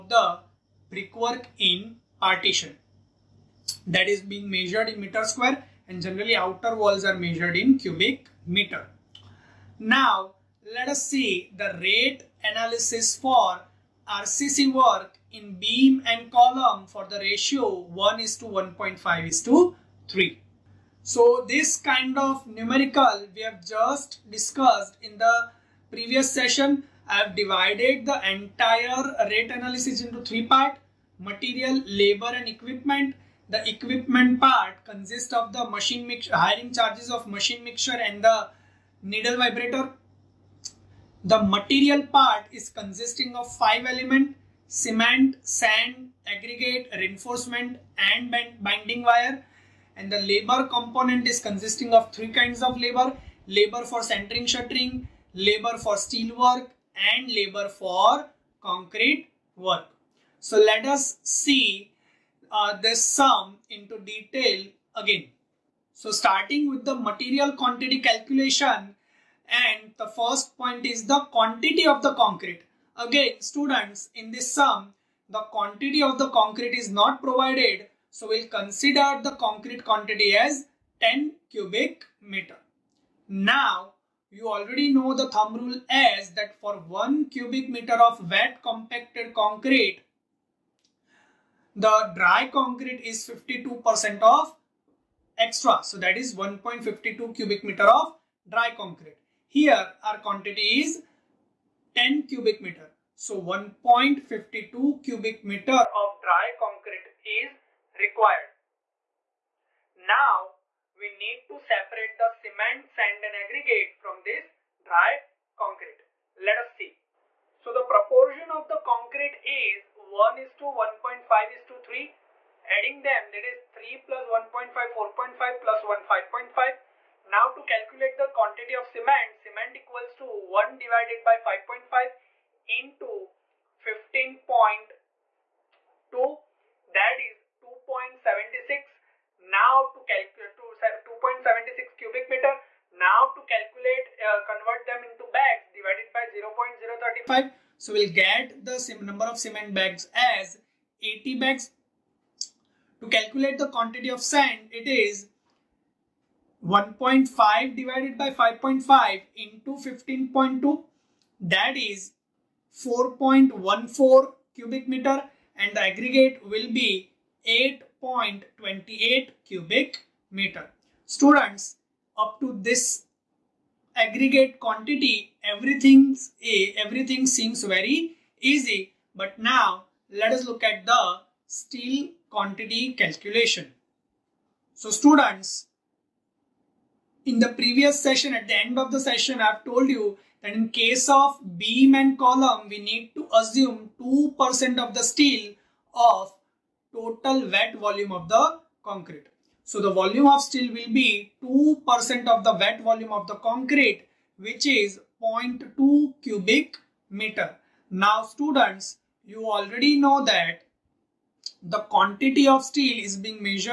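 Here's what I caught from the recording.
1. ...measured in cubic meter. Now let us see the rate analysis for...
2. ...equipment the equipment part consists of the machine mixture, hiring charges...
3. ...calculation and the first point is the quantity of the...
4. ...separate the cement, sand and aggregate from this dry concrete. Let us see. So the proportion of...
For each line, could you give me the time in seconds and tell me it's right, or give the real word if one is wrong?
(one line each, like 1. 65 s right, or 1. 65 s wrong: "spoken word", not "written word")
1. 7 s right
2. 32 s right
3. 68 s right
4. 111 s right.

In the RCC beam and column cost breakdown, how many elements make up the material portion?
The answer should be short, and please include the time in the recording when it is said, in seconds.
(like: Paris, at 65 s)
5, at 43 s.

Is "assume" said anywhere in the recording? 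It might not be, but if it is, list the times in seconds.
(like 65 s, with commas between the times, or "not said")
193 s.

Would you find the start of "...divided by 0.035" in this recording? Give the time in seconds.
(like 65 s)
145 s.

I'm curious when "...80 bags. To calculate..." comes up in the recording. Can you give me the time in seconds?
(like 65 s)
151 s.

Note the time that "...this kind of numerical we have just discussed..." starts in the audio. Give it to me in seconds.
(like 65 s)
21 s.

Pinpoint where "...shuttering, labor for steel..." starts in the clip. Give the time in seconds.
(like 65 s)
54 s.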